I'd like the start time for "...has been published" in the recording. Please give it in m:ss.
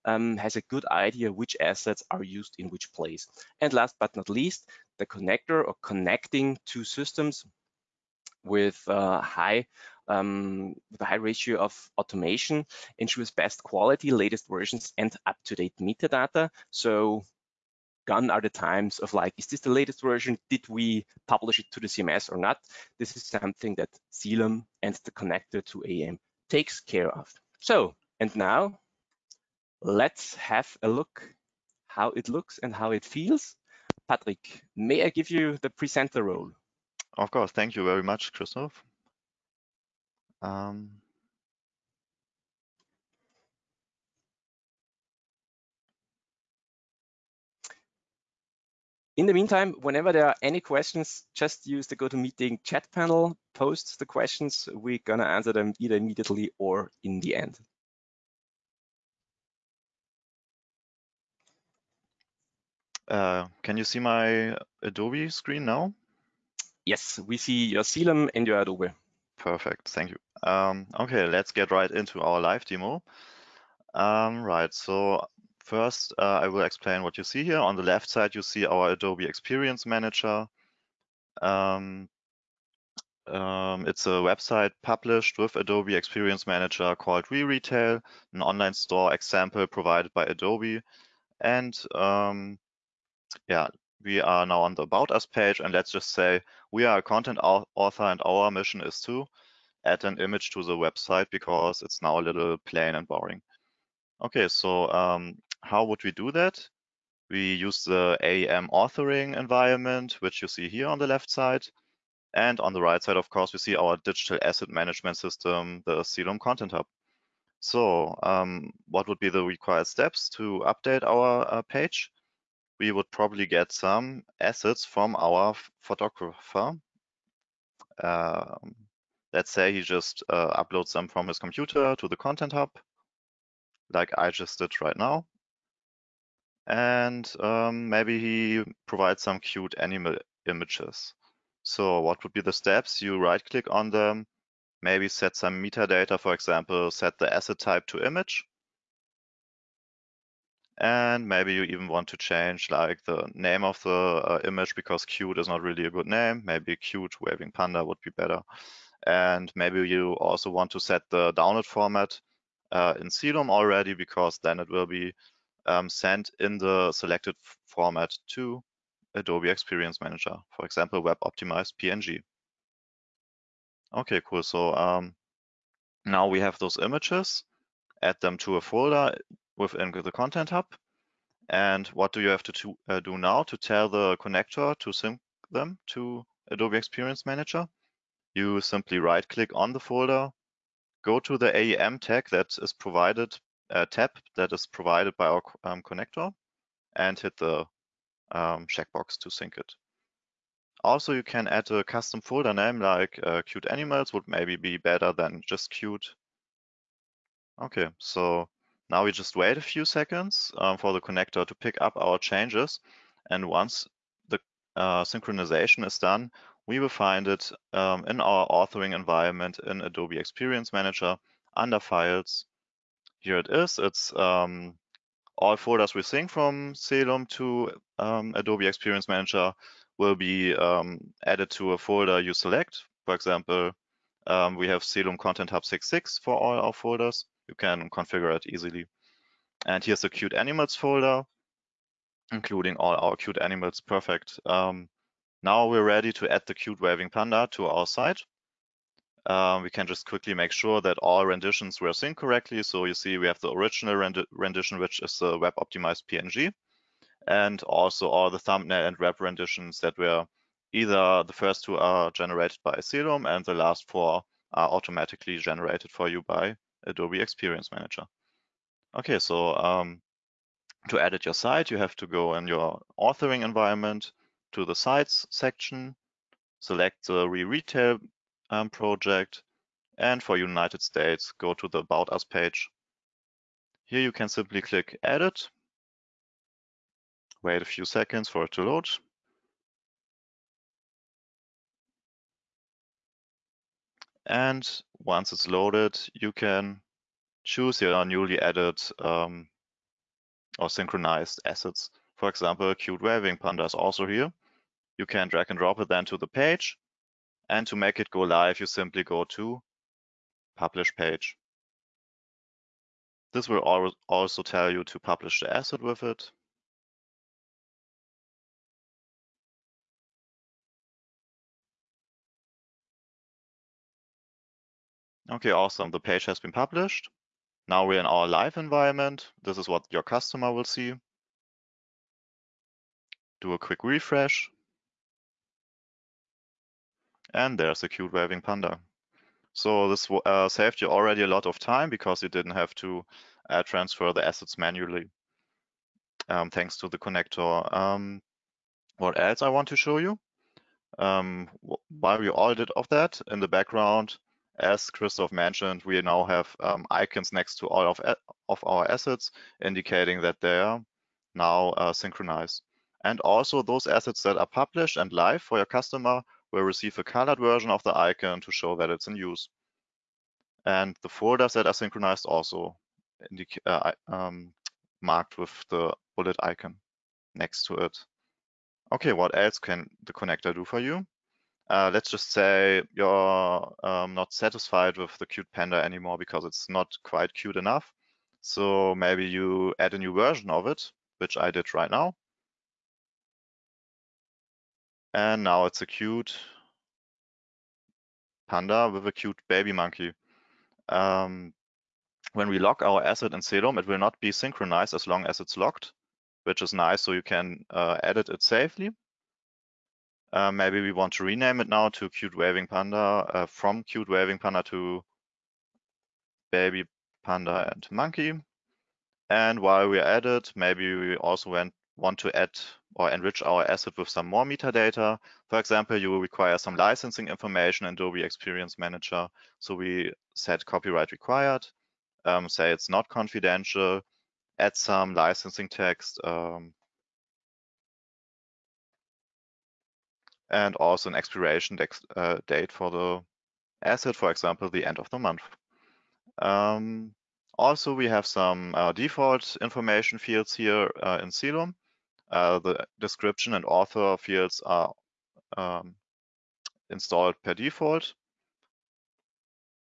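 5:26.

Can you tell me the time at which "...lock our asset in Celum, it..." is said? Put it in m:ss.
6:42.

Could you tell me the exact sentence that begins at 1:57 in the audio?
So um, what would be the required steps to update our uh, page?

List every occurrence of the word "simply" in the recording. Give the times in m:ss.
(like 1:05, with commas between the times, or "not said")
3:08, 4:44, 5:08.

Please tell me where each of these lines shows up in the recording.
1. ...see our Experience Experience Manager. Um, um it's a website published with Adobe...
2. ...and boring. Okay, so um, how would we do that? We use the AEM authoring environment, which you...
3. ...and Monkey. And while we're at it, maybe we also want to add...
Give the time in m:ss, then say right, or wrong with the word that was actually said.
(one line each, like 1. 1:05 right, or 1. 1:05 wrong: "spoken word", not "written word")
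1. 1:18 wrong: "Adobe", not "Experience"
2. 1:42 right
3. 6:57 right.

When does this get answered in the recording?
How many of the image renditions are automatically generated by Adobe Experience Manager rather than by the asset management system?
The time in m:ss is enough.
4:23.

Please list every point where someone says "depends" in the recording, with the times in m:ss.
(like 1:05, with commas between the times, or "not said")
not said.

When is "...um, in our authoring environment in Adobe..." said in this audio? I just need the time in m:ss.
3:37.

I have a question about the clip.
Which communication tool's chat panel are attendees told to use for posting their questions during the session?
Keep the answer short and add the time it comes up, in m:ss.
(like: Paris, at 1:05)
GoToMeeting, at 0:51.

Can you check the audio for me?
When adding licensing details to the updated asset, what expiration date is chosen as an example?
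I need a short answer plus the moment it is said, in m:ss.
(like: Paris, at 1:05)
end of the month, at 7:24.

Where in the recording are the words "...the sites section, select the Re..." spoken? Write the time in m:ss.
4:34.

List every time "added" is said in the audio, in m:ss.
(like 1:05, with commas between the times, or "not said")
3:51, 4:58.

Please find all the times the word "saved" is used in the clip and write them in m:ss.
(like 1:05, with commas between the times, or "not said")
5:40.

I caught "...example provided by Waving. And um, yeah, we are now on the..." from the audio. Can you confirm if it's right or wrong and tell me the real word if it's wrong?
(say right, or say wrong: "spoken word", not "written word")
wrong: "Adobe", not "Waving".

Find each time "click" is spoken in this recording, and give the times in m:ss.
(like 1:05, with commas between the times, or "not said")
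2:23, 3:09, 4:44.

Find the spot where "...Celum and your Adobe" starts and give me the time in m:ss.
1:07.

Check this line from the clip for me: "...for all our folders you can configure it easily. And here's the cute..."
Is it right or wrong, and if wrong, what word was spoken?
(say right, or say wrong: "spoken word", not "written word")
right.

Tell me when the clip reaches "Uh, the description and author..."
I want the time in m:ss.
7:32.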